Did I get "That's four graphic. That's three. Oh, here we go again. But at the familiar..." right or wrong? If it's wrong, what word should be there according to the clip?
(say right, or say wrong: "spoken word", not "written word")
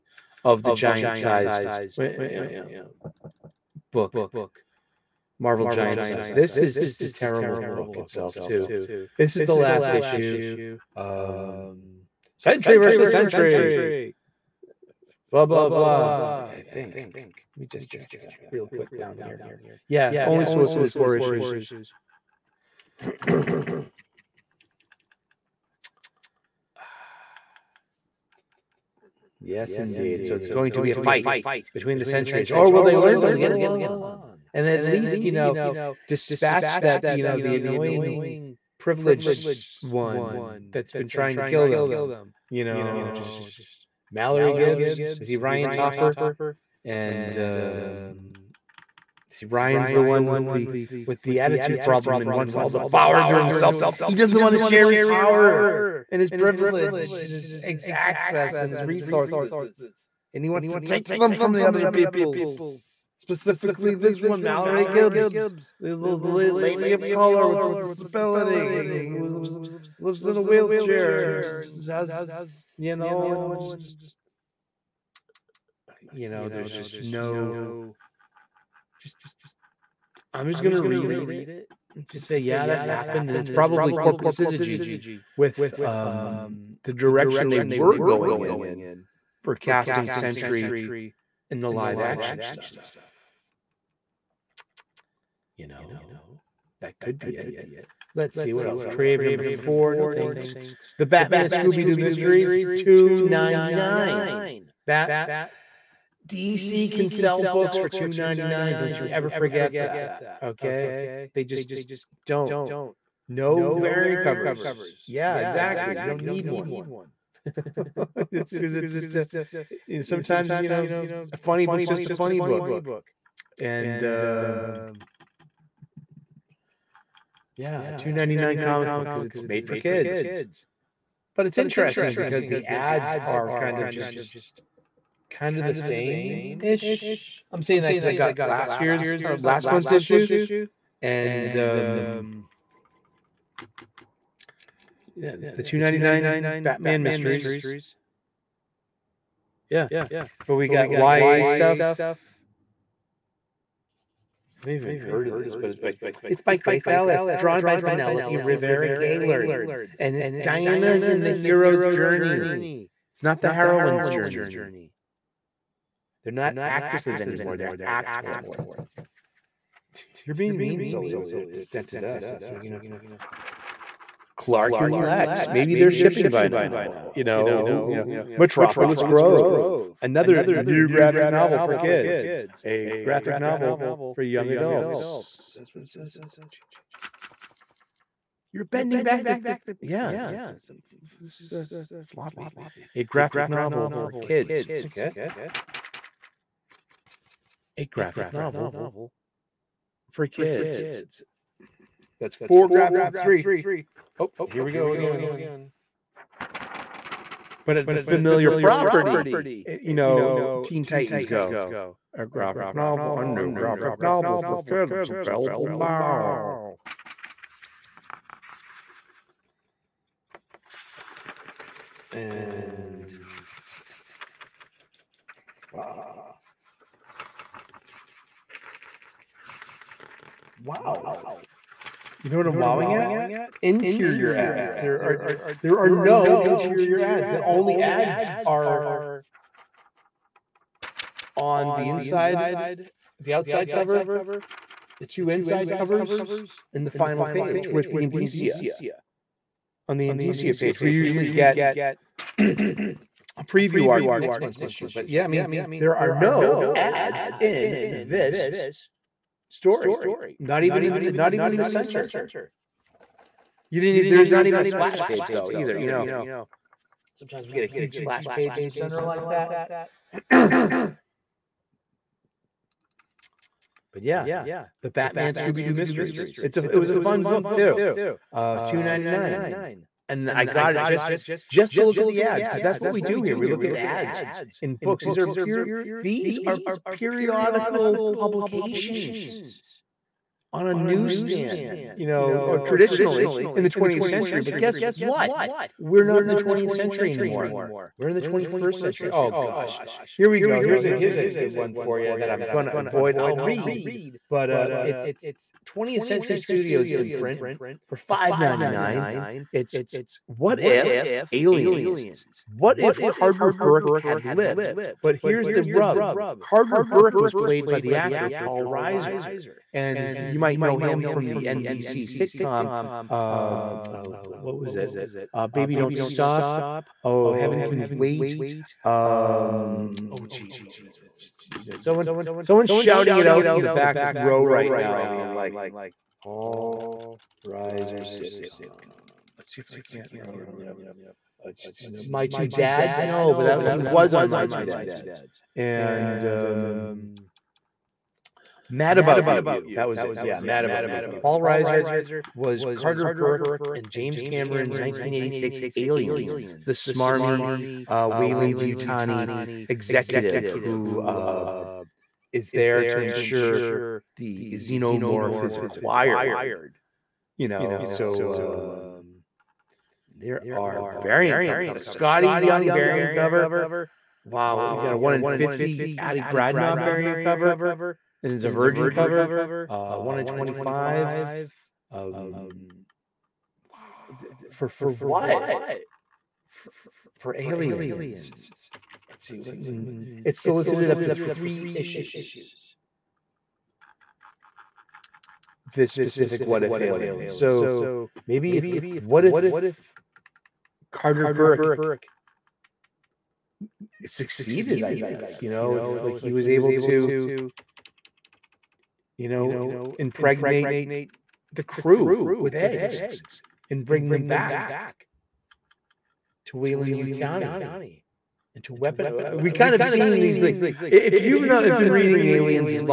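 right.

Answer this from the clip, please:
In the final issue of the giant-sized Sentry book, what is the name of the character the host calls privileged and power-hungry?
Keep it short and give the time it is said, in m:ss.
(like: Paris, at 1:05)
Ryan Topper, at 0:45.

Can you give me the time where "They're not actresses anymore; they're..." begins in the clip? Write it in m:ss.
2:46.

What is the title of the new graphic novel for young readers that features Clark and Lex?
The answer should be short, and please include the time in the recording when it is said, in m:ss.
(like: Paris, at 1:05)
Metropolis Grove, at 2:58.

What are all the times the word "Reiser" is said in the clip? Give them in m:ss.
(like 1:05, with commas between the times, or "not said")
5:18, 5:37, 5:51.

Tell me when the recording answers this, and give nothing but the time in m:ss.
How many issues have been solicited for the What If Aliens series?
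6:31.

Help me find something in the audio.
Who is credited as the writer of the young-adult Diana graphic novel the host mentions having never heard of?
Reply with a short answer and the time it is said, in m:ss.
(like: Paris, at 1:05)
Grace Ellis, at 2:36.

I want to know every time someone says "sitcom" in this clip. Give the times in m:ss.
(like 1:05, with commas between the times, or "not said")
5:22, 5:38.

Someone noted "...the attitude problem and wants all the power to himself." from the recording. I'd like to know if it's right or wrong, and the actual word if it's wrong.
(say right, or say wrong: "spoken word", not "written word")
right.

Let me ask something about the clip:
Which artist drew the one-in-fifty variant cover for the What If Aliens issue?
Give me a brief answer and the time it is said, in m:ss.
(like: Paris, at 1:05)
Adi Granov, at 6:15.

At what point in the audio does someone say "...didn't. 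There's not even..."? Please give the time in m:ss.
4:23.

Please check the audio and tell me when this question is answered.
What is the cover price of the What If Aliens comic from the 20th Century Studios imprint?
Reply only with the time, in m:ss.
5:07.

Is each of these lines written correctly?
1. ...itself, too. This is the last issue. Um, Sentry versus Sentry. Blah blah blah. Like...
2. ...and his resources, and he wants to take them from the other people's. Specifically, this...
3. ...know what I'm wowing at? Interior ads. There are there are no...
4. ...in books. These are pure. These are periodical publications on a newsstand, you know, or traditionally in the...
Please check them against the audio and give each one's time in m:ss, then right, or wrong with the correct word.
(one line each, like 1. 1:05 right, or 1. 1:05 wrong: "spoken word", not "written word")
1. 0:07 right
2. 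0:58 right
3. 3:52 right
4. 4:44 right.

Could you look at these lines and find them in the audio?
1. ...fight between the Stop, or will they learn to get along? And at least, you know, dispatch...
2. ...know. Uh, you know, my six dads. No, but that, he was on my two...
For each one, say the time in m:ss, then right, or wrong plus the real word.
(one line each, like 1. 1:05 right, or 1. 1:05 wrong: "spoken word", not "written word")
1. 0:30 wrong: "Sentries", not "Stop"
2. 5:40 wrong: "two", not "six".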